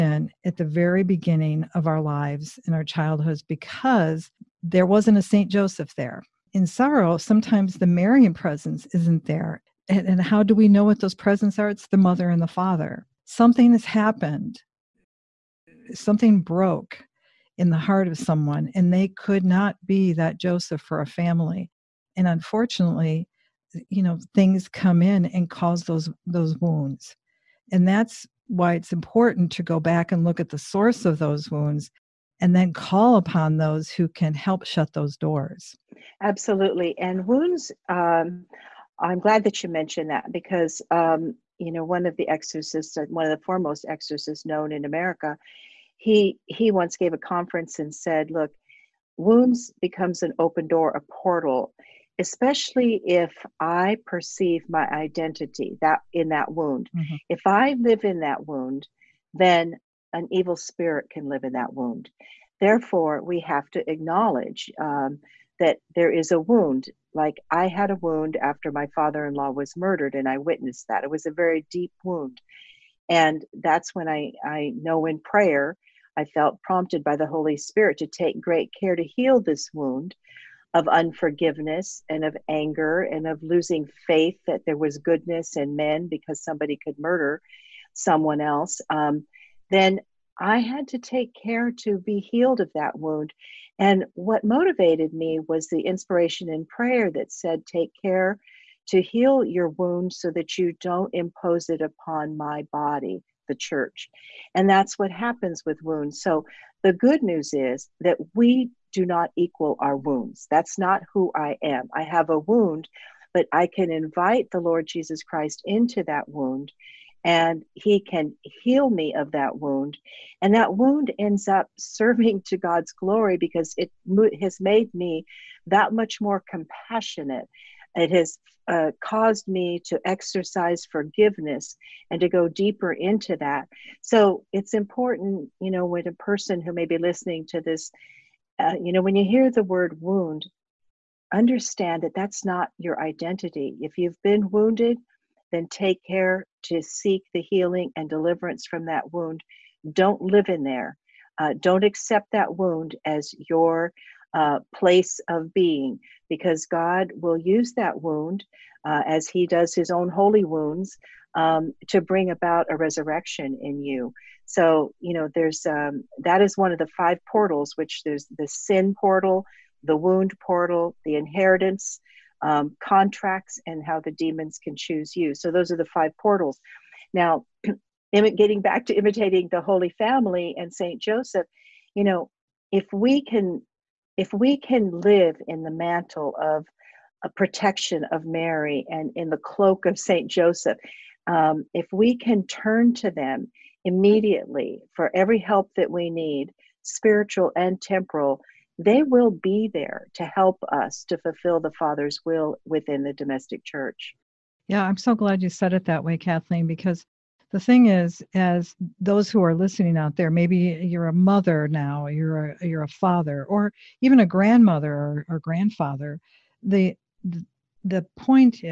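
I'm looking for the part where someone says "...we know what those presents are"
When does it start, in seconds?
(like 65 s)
10 s.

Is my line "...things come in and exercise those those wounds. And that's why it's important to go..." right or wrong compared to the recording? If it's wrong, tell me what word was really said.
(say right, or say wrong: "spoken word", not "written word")
wrong: "cause", not "exercise".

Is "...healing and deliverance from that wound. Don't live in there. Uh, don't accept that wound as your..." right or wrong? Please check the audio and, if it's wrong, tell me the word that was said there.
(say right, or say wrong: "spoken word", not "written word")
right.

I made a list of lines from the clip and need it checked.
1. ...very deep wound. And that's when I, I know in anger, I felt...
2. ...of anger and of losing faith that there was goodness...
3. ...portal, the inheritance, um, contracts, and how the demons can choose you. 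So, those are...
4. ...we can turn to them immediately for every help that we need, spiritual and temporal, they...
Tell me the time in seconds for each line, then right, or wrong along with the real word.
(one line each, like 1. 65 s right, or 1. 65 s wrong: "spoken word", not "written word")
1. 71 s wrong: "prayer", not "anger"
2. 82 s right
3. 170 s right
4. 191 s right.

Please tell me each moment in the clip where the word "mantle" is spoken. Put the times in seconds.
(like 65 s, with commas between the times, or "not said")
185 s.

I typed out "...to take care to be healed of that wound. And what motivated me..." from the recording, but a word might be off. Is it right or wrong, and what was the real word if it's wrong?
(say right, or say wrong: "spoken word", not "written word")
right.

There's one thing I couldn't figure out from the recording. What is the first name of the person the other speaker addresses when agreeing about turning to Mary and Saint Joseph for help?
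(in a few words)
Kathleen.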